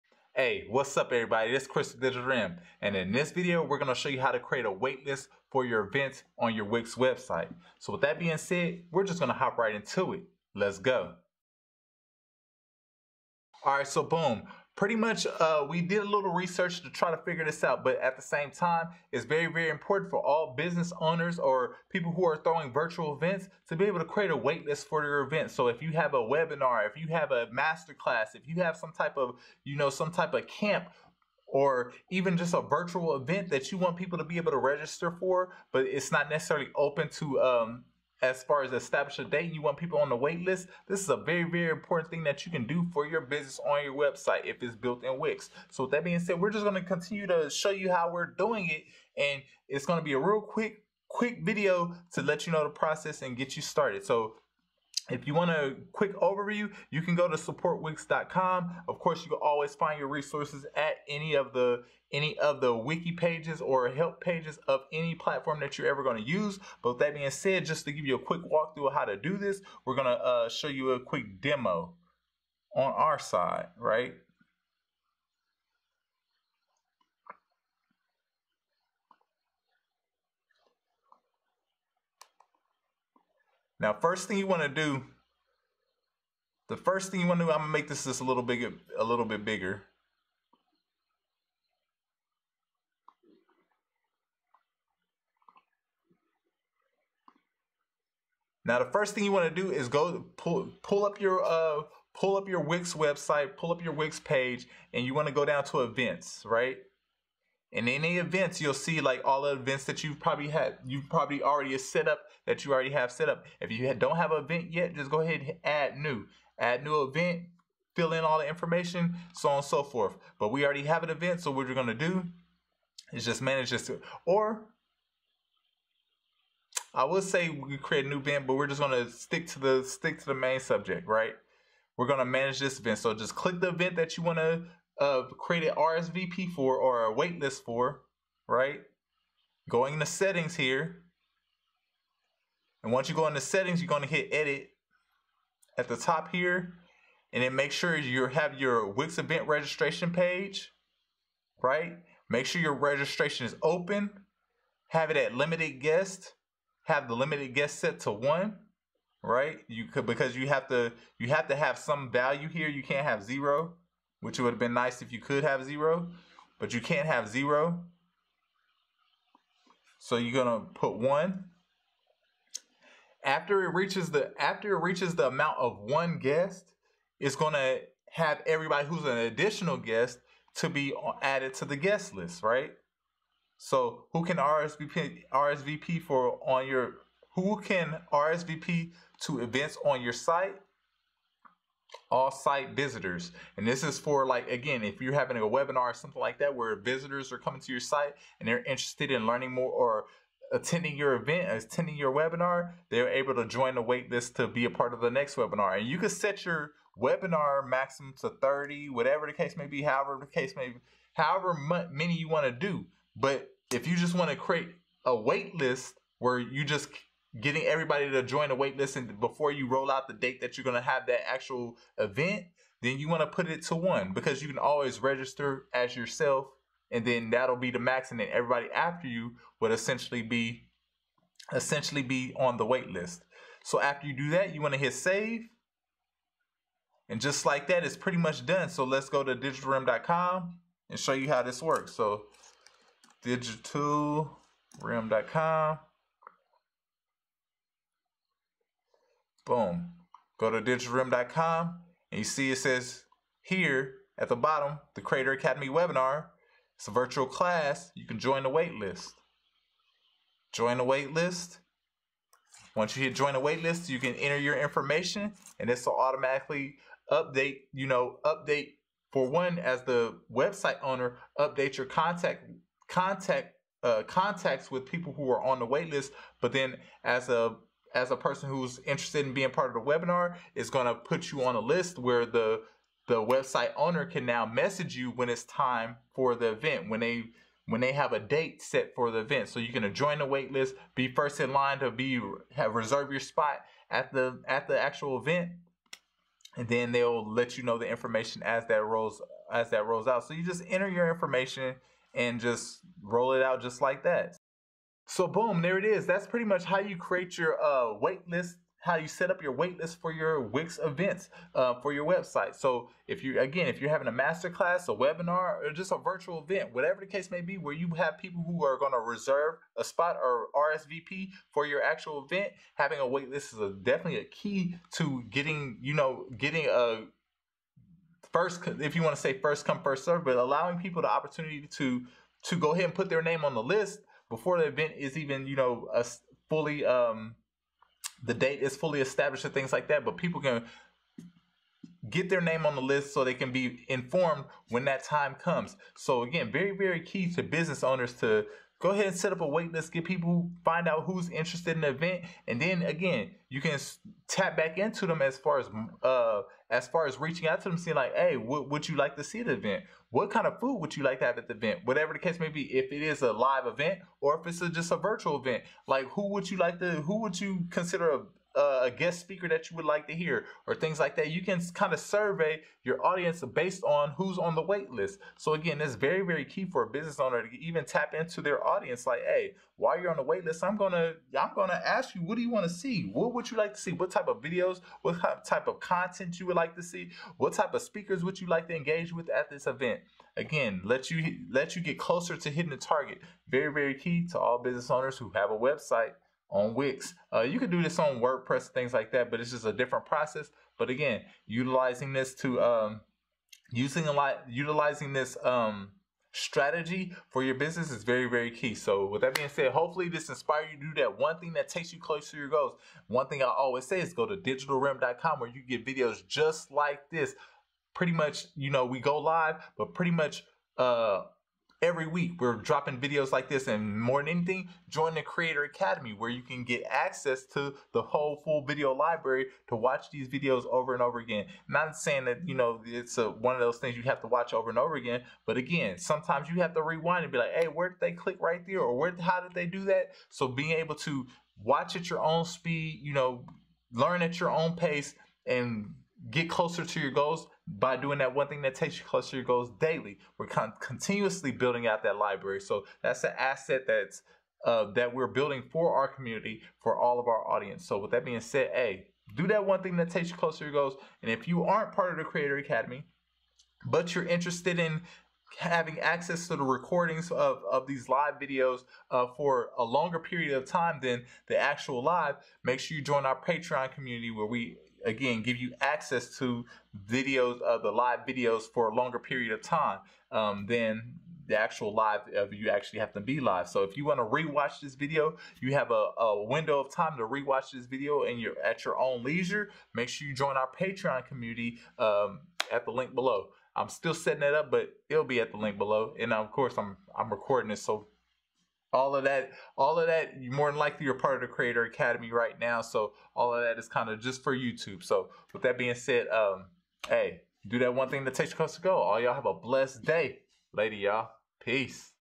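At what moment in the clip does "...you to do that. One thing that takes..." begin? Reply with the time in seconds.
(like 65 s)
410 s.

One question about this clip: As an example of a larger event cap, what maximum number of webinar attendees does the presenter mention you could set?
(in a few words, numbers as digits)
30.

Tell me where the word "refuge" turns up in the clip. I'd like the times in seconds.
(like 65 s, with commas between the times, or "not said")
not said.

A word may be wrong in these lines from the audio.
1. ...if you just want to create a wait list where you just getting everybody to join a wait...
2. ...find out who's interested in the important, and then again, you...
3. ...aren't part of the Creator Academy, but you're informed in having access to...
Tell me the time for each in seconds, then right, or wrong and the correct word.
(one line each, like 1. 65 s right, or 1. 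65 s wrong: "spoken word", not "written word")
1. 213 s right
2. 350 s wrong: "event", not "important"
3. 461 s wrong: "interested", not "informed".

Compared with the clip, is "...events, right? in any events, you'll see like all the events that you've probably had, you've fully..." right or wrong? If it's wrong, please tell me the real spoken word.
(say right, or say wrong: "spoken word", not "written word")
wrong: "probably", not "fully".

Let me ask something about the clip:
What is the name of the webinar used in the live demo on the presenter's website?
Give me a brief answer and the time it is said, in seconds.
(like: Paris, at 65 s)
Creator Academy webinar, at 254 s.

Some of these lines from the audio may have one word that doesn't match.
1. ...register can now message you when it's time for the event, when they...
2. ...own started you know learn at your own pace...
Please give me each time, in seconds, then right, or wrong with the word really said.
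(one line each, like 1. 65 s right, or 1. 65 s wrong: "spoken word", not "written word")
1. 283 s wrong: "owner", not "register"
2. 442 s wrong: "speed", not "started".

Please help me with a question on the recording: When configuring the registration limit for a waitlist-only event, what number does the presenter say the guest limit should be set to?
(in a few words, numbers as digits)
1.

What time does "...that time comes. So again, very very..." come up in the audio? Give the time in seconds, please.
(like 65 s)
344 s.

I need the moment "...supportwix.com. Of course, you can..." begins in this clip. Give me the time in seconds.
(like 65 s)
57 s.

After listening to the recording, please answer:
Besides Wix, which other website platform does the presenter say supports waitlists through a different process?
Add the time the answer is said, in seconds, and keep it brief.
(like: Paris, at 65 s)
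WordPress, at 398 s.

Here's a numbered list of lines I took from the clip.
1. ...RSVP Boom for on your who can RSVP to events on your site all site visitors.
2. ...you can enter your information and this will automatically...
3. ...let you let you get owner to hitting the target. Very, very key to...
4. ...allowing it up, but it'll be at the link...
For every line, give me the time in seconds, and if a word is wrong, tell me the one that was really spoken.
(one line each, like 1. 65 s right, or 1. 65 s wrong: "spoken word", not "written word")
1. 184 s wrong: "RSVP", not "Boom"
2. 263 s right
3. 390 s wrong: "closer", not "owner"
4. 494 s wrong: "setting", not "allowing".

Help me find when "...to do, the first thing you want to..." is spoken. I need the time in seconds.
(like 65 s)
84 s.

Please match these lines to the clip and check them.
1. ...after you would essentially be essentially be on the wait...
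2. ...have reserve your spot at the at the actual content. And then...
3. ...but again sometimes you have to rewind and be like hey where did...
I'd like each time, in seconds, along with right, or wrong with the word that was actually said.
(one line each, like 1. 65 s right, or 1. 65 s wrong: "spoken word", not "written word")
1. 228 s right
2. 292 s wrong: "event", not "content"
3. 435 s right.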